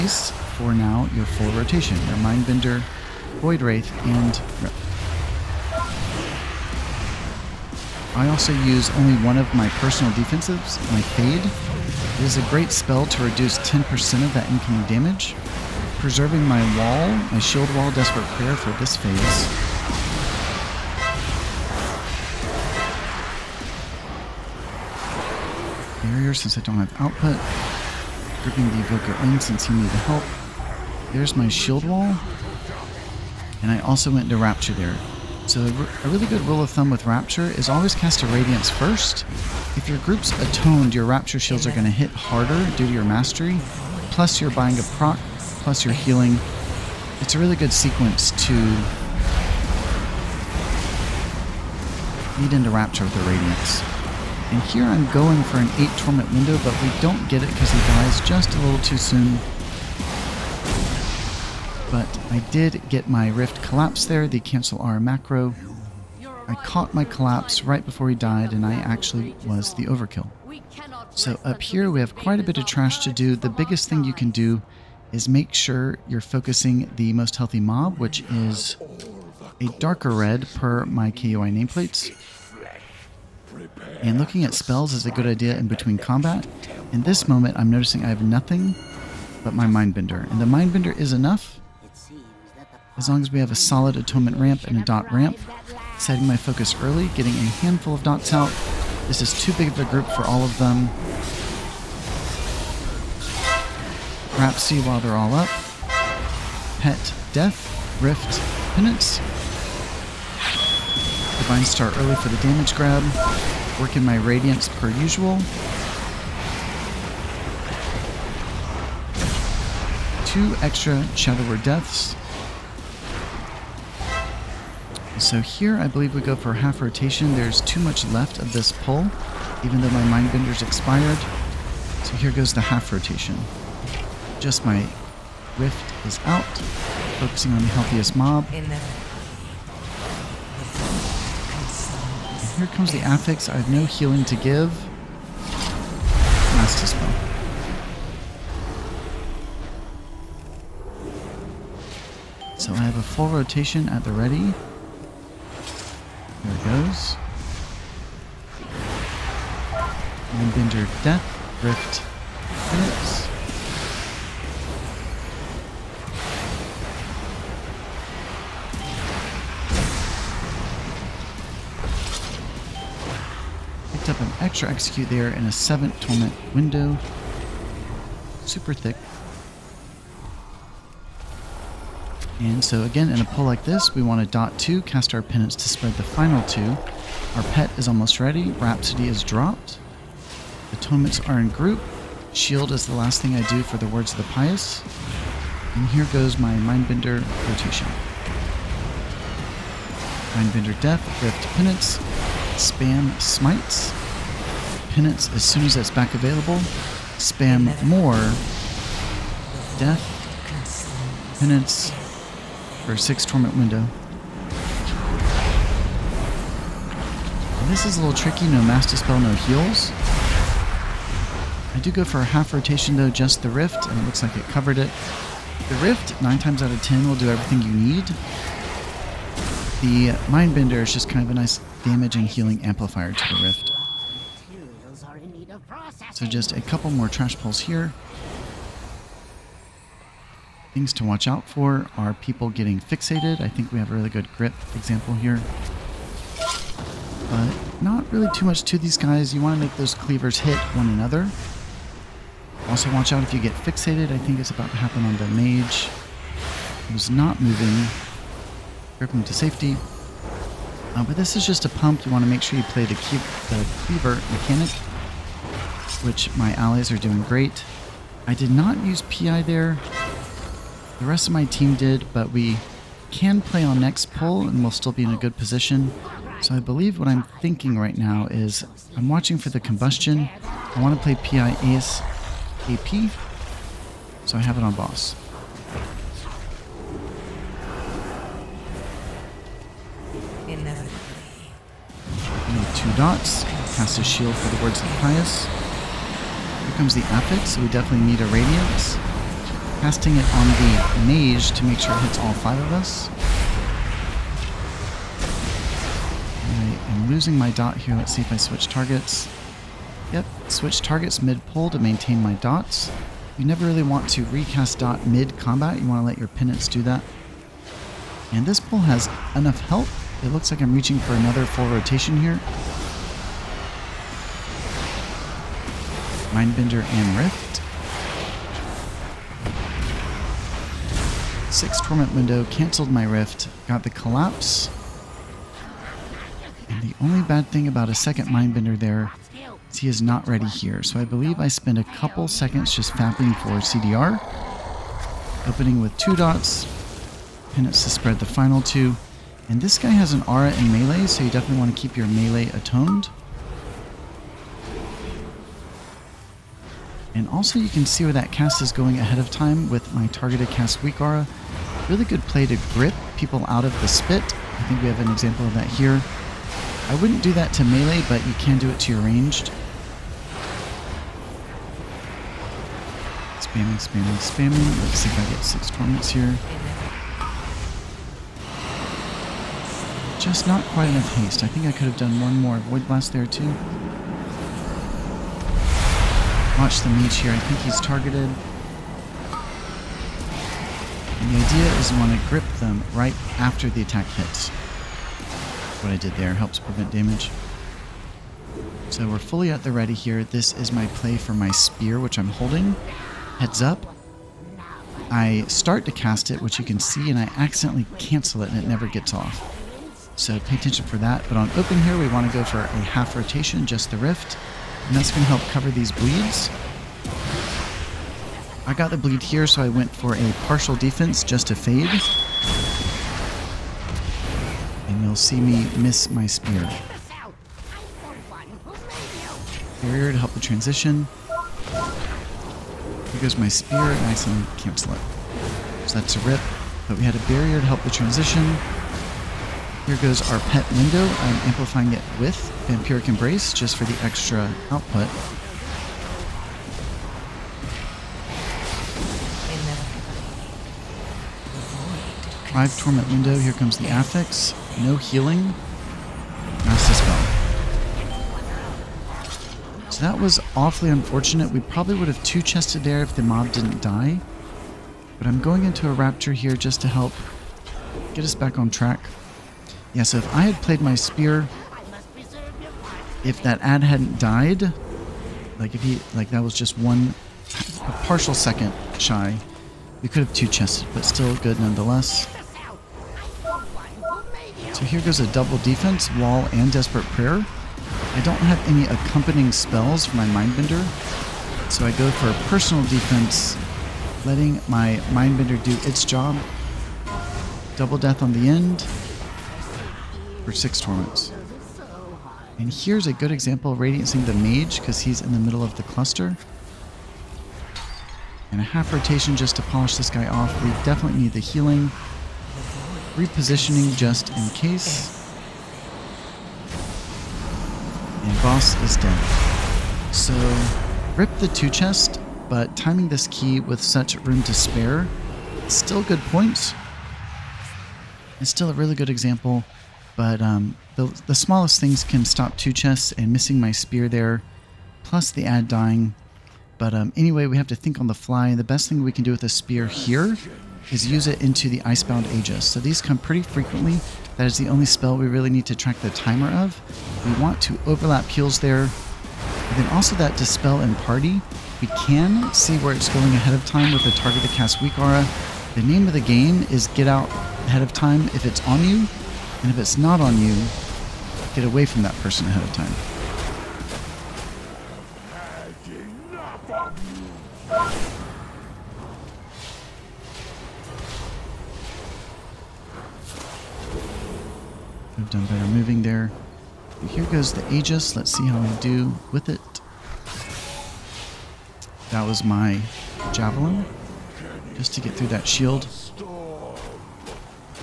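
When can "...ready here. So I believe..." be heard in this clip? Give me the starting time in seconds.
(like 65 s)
340 s.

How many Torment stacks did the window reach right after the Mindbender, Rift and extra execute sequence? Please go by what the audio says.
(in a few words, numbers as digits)
7.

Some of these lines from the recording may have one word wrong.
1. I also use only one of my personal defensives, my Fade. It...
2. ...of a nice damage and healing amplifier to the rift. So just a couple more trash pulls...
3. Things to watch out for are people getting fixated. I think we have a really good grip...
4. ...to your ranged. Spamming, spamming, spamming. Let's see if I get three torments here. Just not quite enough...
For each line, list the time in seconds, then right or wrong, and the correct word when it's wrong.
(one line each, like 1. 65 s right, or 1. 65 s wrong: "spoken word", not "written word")
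1. 8 s right
2. 231 s right
3. 240 s right
4. 368 s wrong: "six", not "three".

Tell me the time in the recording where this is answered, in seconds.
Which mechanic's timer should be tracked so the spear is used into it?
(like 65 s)
541 s.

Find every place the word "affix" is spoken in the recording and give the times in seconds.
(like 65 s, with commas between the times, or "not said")
143 s, 453 s.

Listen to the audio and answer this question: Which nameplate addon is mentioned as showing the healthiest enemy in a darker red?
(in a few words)
KUI nameplates.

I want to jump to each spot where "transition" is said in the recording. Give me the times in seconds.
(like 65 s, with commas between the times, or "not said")
430 s, 437 s.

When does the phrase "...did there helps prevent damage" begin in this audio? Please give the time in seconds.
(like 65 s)
395 s.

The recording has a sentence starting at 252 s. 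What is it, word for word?
Also watch out if you get fixated.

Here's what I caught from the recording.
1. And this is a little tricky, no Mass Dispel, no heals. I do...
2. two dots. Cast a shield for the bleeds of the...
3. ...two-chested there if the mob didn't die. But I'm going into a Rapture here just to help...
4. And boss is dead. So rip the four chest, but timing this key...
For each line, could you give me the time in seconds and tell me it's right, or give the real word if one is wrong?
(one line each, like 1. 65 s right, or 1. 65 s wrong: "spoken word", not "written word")
1. 217 s right
2. 292 s wrong: "words", not "bleeds"
3. 462 s right
4. 518 s wrong: "two", not "four".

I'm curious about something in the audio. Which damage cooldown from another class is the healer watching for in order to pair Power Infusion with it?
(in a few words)
combustion.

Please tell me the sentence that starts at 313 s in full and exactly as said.
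You never really want to recast dot mid-combat.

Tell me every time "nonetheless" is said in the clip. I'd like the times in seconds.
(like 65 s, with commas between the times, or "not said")
481 s.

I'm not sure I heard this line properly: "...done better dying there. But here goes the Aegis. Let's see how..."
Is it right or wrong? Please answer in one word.
wrong.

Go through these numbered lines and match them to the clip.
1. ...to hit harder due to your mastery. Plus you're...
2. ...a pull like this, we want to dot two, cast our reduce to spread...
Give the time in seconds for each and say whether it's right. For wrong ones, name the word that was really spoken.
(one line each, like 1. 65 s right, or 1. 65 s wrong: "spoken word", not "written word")
1. 41 s right
2. 183 s wrong: "penance", not "reduce".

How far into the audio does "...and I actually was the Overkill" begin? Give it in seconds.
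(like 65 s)
68 s.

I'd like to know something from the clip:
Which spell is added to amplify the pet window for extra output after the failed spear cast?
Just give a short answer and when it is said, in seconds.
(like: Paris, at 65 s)
Vampiric Embrace, at 442 s.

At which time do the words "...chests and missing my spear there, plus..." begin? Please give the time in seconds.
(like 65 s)
532 s.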